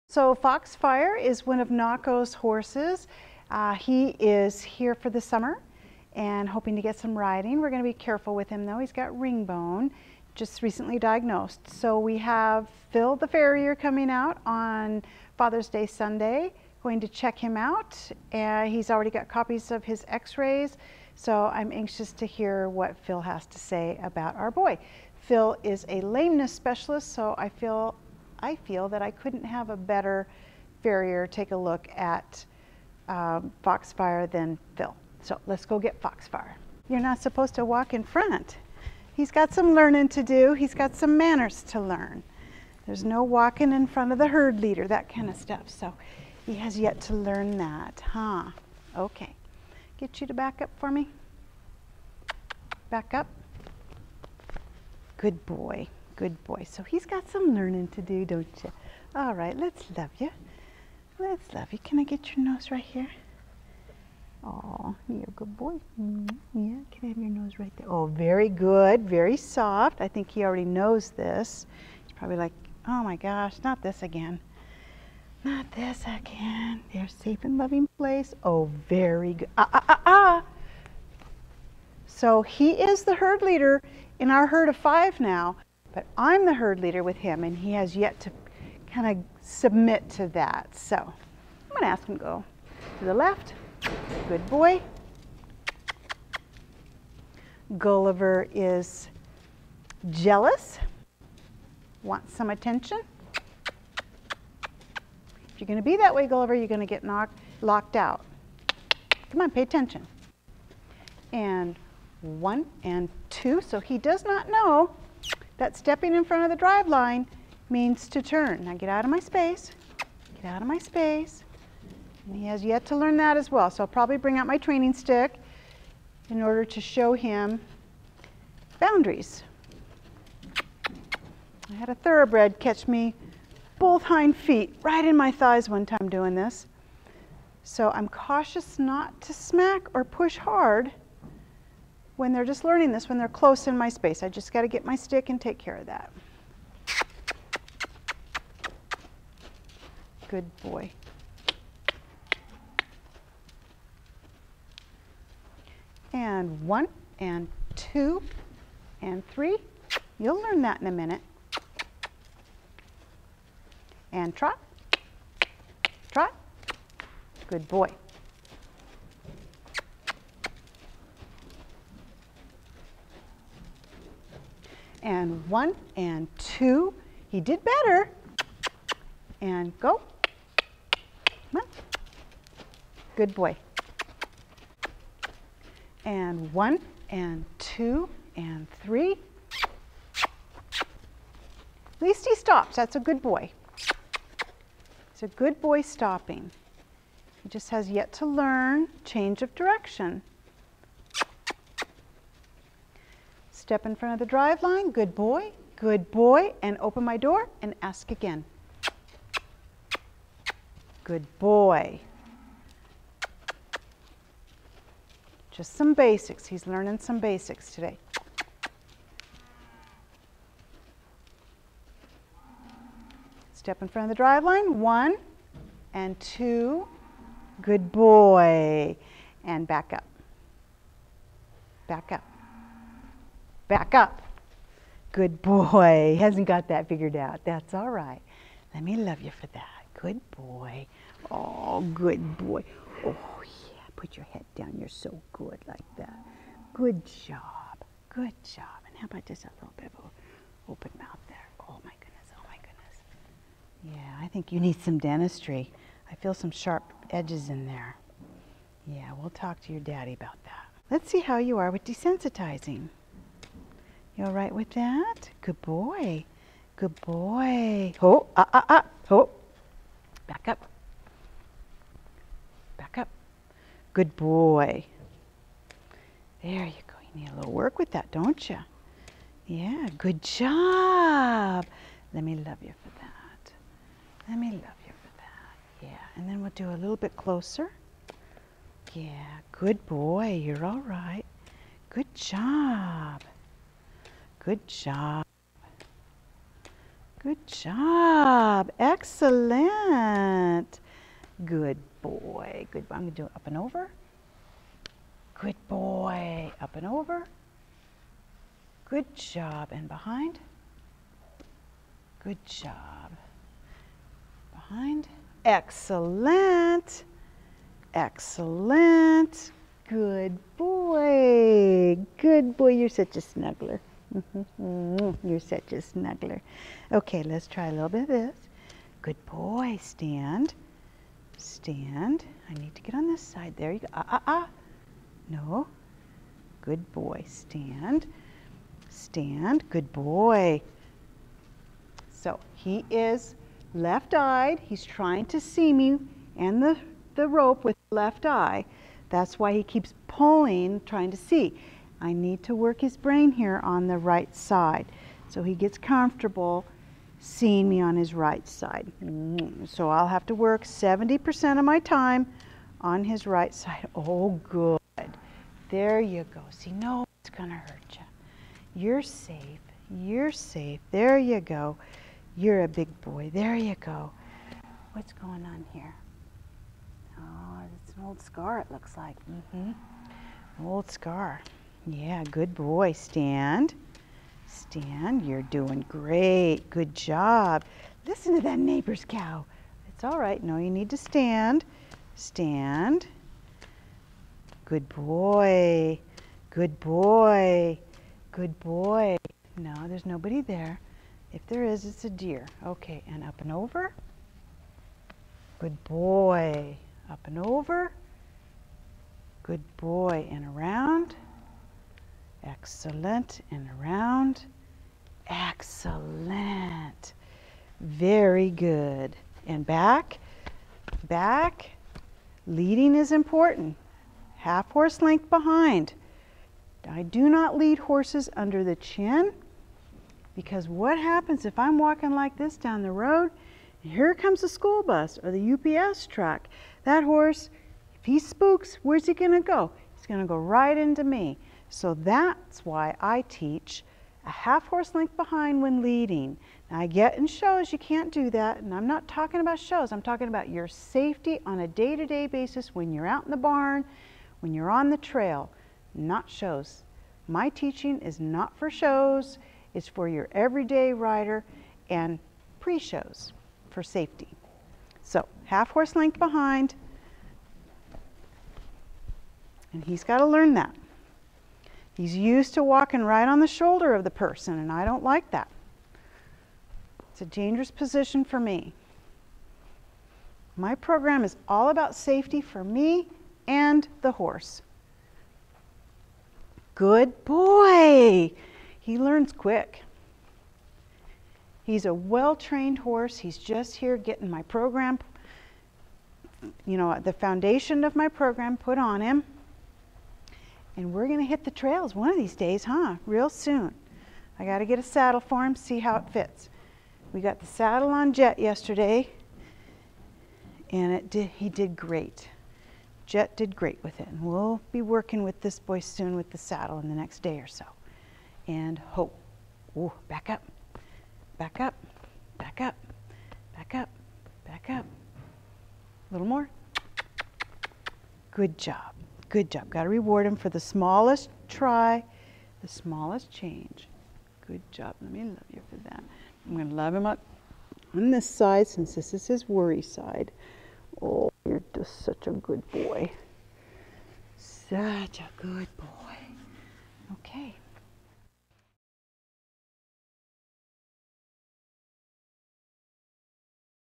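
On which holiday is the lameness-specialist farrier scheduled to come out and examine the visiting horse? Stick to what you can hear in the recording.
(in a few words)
Father's Day.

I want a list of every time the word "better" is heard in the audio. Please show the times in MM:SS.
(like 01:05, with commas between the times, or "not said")
00:29, 02:57.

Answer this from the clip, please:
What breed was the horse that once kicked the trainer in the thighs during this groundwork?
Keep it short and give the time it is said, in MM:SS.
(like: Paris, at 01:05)
Thoroughbred, at 02:11.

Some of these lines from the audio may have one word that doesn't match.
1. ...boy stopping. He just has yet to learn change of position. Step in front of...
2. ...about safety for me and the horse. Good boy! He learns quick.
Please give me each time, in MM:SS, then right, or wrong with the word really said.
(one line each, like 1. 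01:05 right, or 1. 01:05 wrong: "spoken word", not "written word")
1. 03:15 wrong: "direction", not "position"
2. 08:01 right.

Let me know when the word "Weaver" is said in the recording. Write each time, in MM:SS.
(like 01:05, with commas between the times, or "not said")
not said.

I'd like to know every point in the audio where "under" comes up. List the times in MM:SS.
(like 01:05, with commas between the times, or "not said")
07:08.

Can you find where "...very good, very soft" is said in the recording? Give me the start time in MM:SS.
01:08.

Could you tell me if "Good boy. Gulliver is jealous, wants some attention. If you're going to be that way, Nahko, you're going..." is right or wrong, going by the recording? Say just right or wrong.
wrong.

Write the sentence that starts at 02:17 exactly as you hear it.
So I'm cautious not to smack or push hard when they're just learning this, when they're close in my space.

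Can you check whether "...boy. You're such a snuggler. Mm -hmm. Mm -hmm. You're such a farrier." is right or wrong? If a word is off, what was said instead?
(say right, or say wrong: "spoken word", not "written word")
wrong: "snuggler", not "farrier".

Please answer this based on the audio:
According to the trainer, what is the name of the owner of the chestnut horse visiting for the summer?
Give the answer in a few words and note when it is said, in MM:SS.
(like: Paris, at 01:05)
Nahko, at 00:01.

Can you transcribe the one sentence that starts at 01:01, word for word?
Can I get your nose right here?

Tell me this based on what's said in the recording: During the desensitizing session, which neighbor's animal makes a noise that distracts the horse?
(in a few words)
Cow.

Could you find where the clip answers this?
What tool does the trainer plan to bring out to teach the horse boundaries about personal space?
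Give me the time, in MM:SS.
02:04.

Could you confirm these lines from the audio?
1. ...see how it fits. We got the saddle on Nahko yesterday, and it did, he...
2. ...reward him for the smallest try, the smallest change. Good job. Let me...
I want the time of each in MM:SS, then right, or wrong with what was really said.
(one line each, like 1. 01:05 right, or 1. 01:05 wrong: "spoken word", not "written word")
1. 08:25 wrong: "Jet", not "Nahko"
2. 08:49 right.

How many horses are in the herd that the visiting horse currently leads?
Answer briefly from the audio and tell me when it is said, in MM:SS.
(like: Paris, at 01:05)
5, at 01:24.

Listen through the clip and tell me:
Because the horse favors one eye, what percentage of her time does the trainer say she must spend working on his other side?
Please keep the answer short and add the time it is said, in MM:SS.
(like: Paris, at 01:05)
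70%, at 06:00.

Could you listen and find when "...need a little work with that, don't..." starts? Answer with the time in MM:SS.
04:37.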